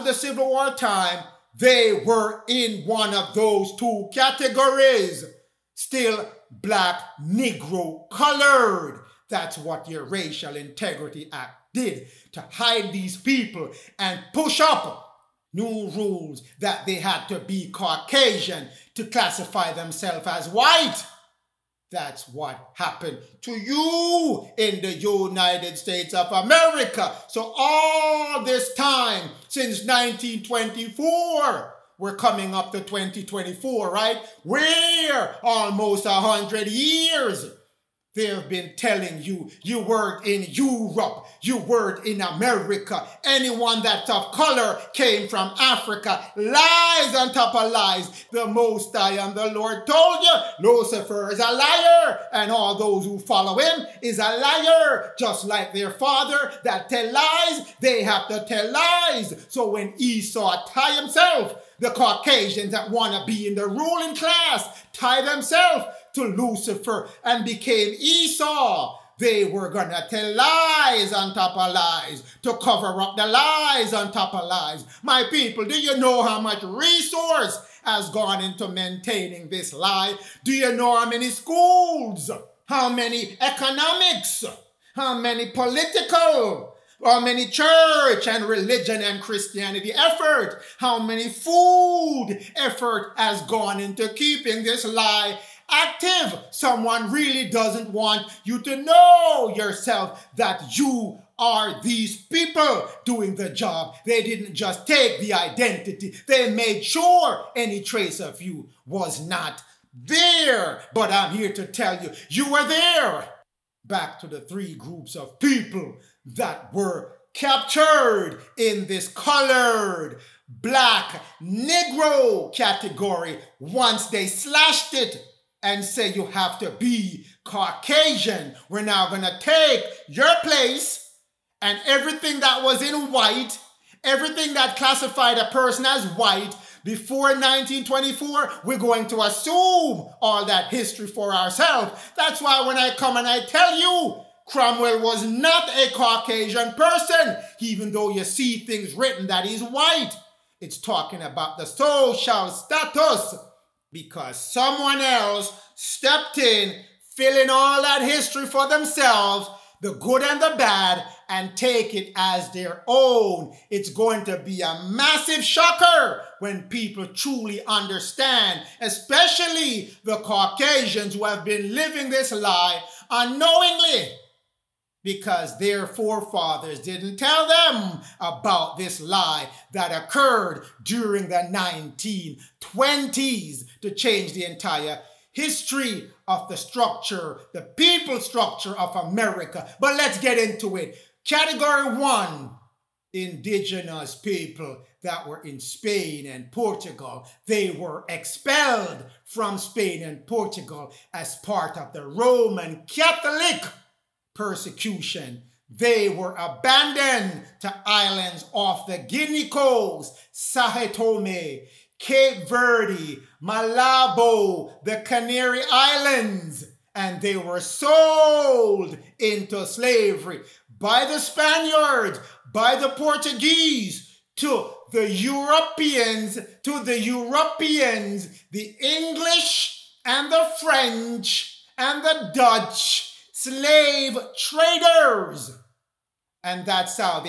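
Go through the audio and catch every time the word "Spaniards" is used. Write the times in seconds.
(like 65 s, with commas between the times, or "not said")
221 s.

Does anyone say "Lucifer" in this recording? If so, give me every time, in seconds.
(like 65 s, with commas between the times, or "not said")
50 s, 66 s.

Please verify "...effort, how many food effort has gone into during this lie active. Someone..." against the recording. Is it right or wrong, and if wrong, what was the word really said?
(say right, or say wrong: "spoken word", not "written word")
wrong: "keeping", not "during".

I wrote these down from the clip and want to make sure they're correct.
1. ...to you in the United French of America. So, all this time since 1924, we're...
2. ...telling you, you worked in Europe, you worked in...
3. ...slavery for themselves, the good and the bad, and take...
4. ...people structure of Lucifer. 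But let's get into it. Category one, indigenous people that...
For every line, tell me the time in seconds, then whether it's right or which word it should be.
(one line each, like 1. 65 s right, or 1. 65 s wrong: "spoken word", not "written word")
1. 23 s wrong: "States", not "French"
2. 38 s right
3. 158 s wrong: "history", not "slavery"
4. 187 s wrong: "America", not "Lucifer".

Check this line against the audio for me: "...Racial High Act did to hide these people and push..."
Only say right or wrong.
wrong.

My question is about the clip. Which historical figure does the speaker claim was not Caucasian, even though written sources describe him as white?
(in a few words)
Cromwell.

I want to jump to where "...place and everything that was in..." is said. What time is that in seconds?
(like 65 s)
130 s.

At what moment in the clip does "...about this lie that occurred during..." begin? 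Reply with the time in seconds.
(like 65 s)
178 s.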